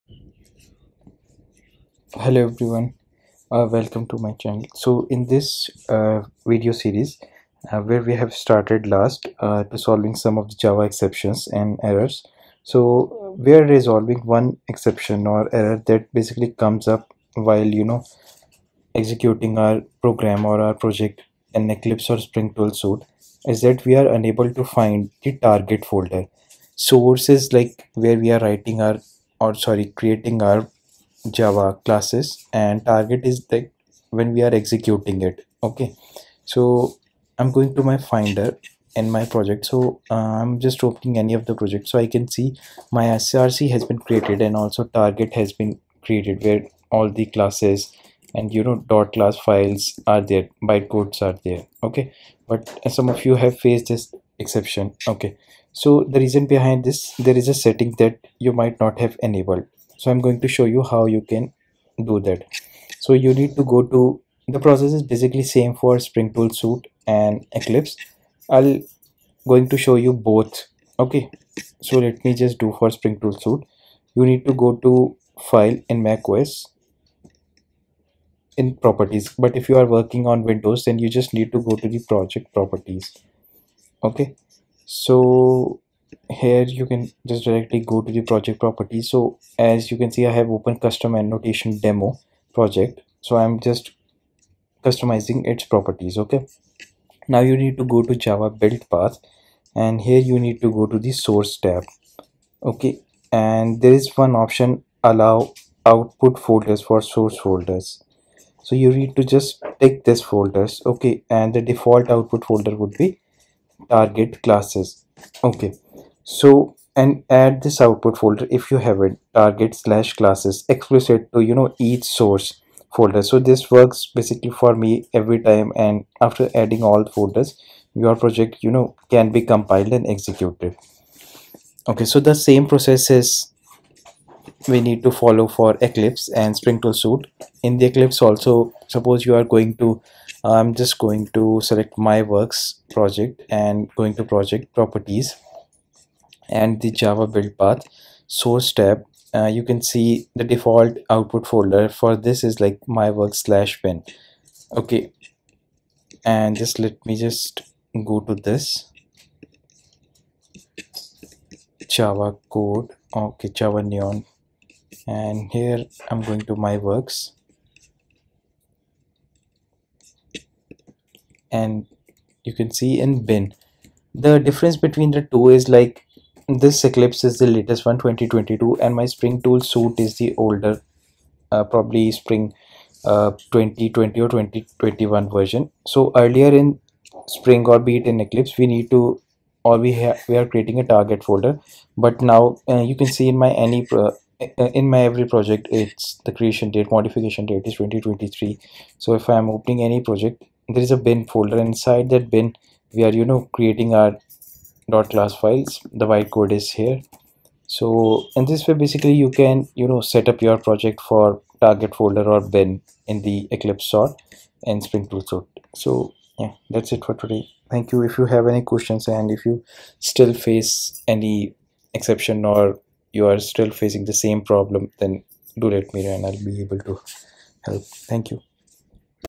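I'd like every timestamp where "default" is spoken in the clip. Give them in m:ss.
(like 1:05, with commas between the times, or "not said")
1:51, 2:30.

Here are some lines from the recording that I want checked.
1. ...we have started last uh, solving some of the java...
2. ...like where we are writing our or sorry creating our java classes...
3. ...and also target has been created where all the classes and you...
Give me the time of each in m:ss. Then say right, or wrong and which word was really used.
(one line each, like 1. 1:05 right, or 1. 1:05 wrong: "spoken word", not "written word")
1. 0:08 right
2. 0:27 right
3. 0:44 right.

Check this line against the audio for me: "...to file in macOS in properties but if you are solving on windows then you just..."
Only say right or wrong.
wrong.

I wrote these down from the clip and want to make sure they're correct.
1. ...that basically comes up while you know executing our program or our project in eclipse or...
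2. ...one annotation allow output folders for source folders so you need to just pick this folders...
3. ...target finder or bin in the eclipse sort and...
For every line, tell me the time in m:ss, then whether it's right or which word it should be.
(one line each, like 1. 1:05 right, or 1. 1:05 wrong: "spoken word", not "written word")
1. 0:15 right
2. 1:44 wrong: "option", not "annotation"
3. 3:31 wrong: "folder", not "finder".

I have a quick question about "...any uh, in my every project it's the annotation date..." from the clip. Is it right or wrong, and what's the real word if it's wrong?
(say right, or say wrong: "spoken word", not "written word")
wrong: "creation", not "annotation".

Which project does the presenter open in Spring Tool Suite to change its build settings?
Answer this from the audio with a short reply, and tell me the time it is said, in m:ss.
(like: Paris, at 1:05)
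custom annotation demo, at 1:30.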